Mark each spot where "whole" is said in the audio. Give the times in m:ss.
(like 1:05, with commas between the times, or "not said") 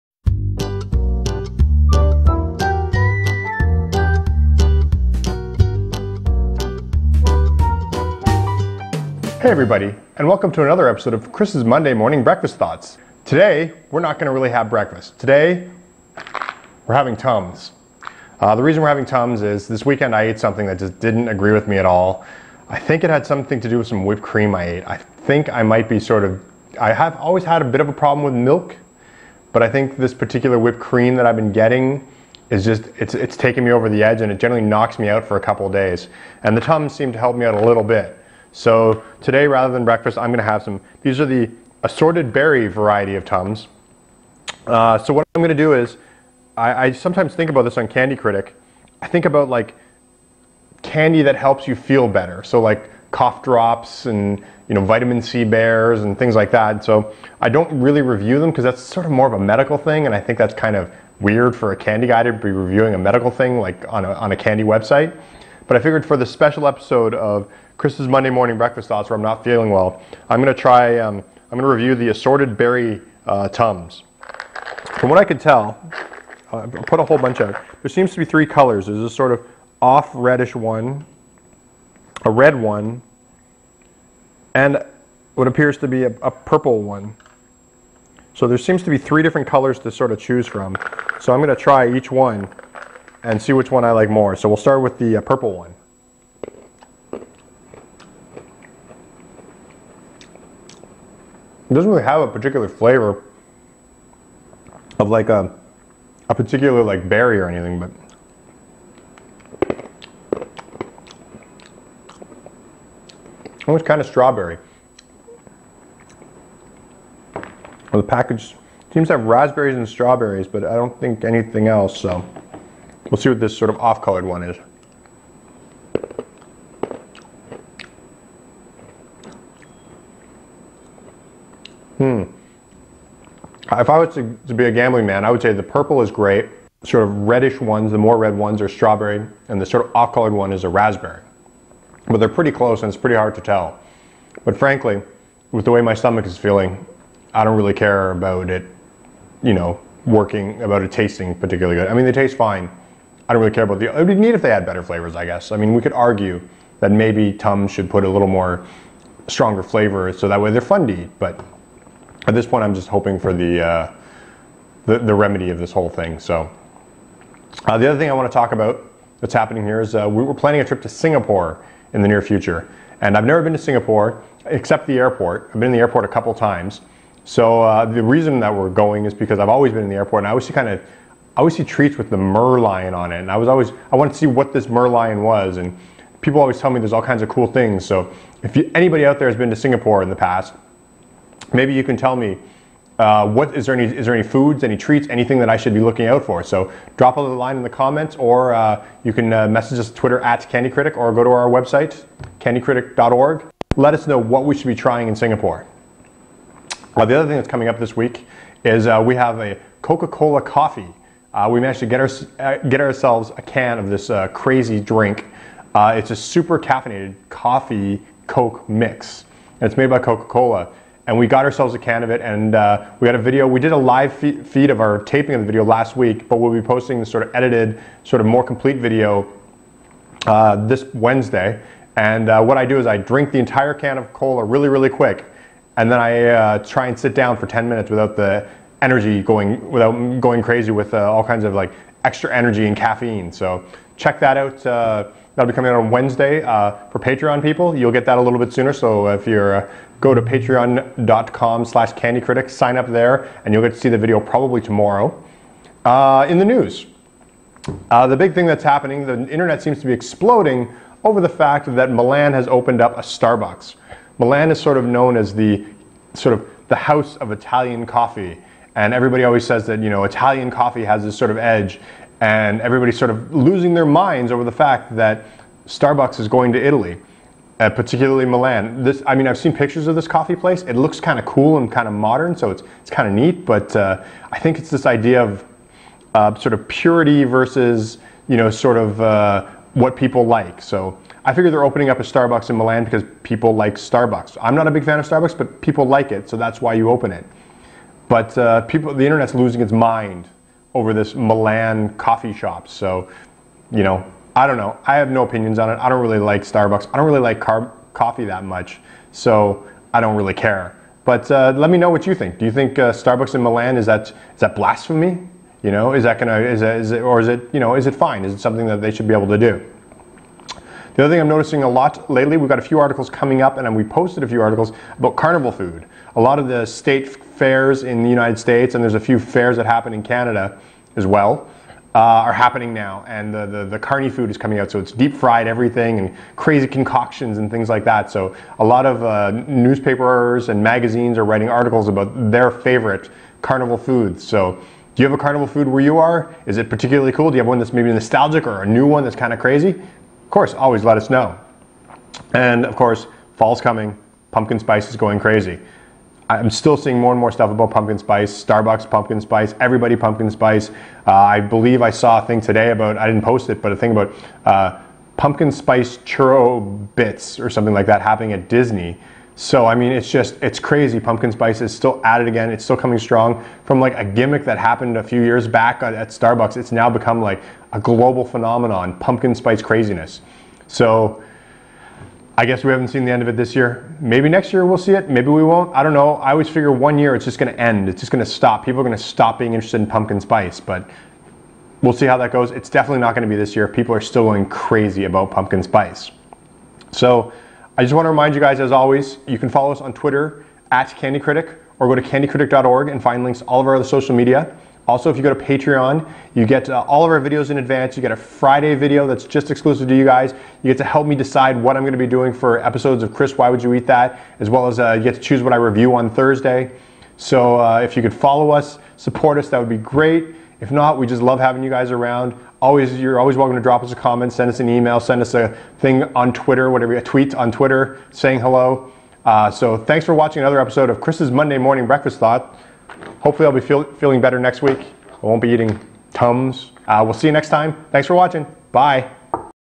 1:17, 2:45.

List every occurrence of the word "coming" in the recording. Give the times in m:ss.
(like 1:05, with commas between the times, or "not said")
3:27, 4:05, 5:23, 5:34, 5:53, 6:12.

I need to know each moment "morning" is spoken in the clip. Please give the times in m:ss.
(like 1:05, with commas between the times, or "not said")
0:11, 1:08, 7:11.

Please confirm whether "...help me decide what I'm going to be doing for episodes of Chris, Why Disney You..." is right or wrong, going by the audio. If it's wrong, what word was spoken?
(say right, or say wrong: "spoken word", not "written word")
wrong: "Would", not "Disney".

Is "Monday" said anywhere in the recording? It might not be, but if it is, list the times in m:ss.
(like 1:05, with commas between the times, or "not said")
0:11, 1:08, 7:11.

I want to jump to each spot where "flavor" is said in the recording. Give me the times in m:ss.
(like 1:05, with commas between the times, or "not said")
1:42, 2:34, 2:39.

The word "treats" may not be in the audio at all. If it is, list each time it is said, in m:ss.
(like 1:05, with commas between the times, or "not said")
3:01, 3:14.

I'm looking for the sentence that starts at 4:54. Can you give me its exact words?
I'm not a big fan of Starbucks, but people like it, so that's why you open it.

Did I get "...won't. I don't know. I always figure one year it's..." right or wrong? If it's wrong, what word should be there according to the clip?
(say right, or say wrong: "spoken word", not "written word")
right.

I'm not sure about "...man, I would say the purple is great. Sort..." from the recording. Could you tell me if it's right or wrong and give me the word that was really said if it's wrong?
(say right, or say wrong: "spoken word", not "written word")
right.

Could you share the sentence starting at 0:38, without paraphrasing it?
So today, rather than breakfast, I'm going to have some, these are the assorted berry variety of Tums.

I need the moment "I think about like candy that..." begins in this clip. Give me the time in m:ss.
0:49.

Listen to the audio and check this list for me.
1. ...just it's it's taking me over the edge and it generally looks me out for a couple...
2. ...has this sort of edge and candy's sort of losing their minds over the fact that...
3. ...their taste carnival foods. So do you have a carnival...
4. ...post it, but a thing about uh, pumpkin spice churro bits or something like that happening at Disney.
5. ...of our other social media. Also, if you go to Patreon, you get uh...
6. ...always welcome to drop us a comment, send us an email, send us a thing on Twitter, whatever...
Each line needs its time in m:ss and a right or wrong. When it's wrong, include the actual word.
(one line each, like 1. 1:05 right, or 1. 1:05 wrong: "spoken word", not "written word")
1. 0:32 wrong: "knocks", not "looks"
2. 4:30 wrong: "everybody", not "candy"
3. 5:42 wrong: "favorite", not "taste"
4. 6:03 right
5. 6:43 right
6. 7:03 right.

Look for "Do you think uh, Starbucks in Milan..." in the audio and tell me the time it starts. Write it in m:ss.
5:12.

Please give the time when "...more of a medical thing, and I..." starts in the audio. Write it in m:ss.
0:59.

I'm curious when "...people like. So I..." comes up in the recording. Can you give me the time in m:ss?
4:49.